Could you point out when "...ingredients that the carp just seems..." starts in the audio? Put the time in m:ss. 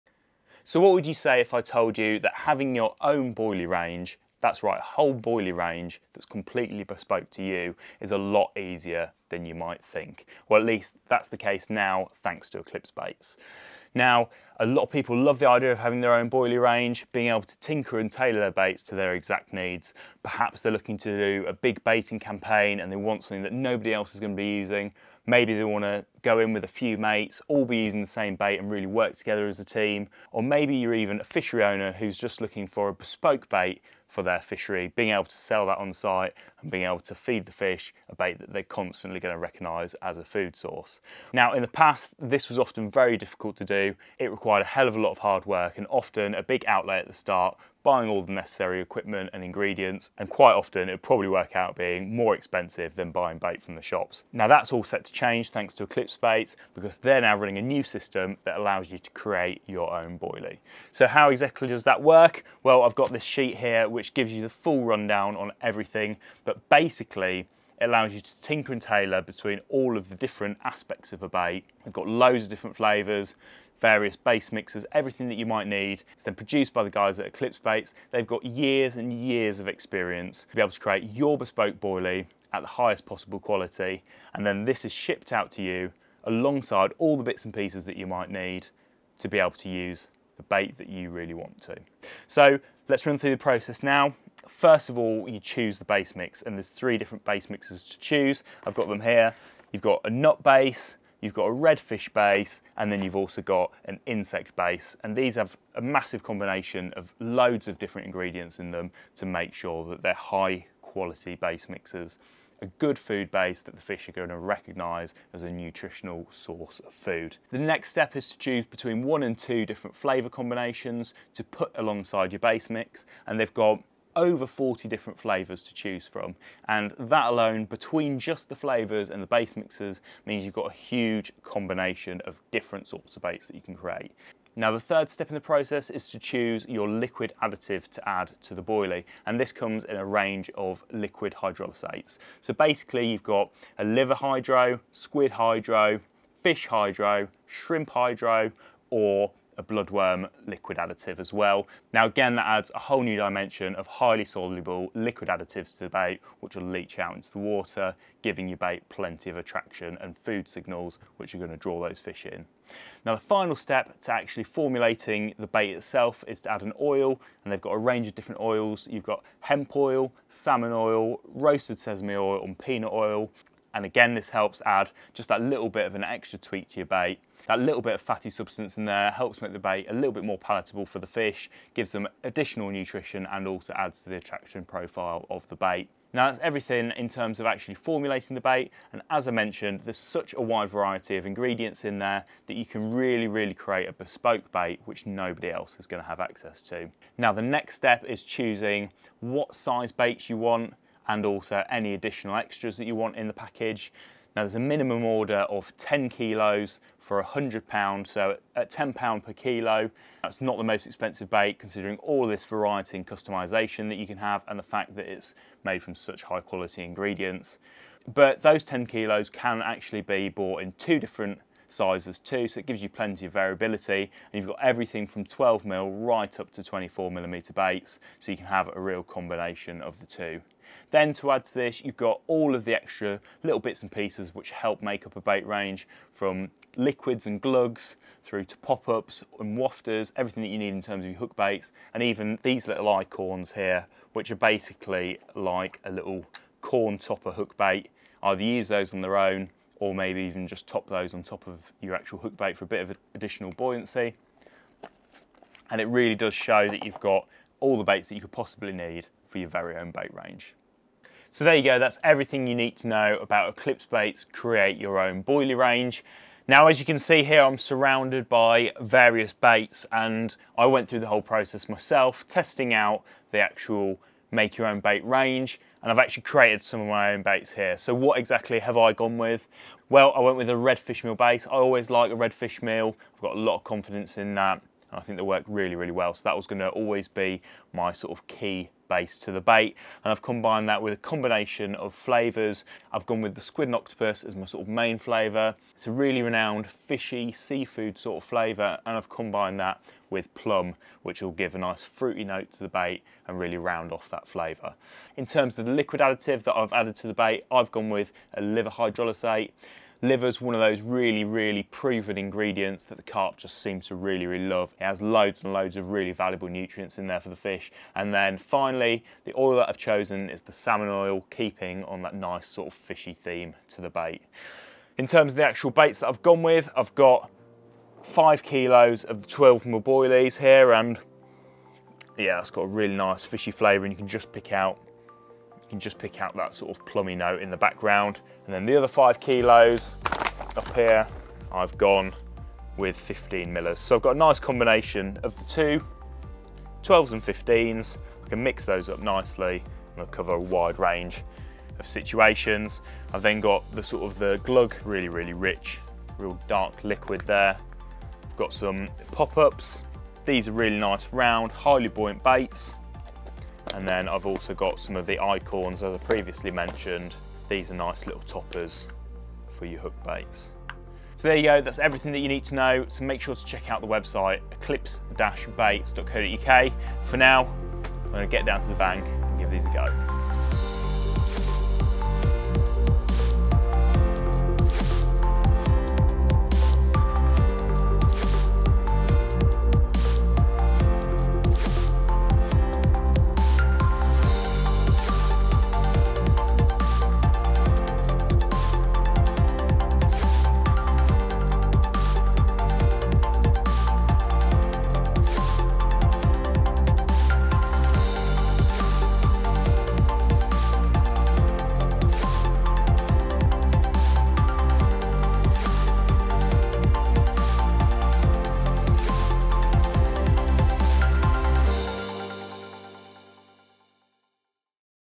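5:12.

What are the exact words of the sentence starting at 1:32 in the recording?
So let's run through the process now.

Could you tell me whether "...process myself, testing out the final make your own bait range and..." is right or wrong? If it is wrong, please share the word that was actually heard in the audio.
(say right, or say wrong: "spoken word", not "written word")
wrong: "actual", not "final".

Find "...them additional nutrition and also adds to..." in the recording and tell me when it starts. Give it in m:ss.
3:01.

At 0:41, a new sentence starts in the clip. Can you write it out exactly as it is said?
Now, in the past, this was often very difficult to do.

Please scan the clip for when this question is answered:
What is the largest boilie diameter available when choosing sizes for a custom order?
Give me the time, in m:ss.
3:46.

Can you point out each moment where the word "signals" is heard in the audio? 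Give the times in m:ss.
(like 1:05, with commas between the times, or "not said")
2:40.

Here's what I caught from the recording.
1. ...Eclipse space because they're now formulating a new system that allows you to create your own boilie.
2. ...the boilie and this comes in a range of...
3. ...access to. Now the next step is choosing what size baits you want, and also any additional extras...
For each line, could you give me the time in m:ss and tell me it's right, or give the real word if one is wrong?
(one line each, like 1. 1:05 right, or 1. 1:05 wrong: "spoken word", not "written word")
1. 0:55 wrong: "running", not "formulating"
2. 2:18 right
3. 3:16 right.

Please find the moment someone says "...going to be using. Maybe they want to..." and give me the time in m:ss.
0:24.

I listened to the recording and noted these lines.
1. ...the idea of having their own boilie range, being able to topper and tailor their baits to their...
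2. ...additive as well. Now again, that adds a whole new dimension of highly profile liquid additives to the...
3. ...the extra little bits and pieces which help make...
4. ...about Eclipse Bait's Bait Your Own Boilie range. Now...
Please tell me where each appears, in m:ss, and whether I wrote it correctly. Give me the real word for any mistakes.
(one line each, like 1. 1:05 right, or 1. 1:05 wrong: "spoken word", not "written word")
1. 0:15 wrong: "tinker", not "topper"
2. 2:30 wrong: "soluble", not "profile"
3. 3:52 right
4. 4:23 wrong: "Create", not "Bait".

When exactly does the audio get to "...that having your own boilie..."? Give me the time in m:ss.
0:02.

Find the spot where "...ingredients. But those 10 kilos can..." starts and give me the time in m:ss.
3:36.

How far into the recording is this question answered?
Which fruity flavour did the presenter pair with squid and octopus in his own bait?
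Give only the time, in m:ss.
5:00.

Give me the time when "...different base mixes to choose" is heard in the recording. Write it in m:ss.
1:36.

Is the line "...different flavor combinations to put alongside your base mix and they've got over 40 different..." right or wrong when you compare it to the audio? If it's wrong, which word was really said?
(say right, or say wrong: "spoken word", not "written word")
right.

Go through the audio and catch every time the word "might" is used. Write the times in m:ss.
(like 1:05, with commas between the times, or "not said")
0:09, 1:15, 1:28.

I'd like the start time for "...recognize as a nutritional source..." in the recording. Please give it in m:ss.
1:54.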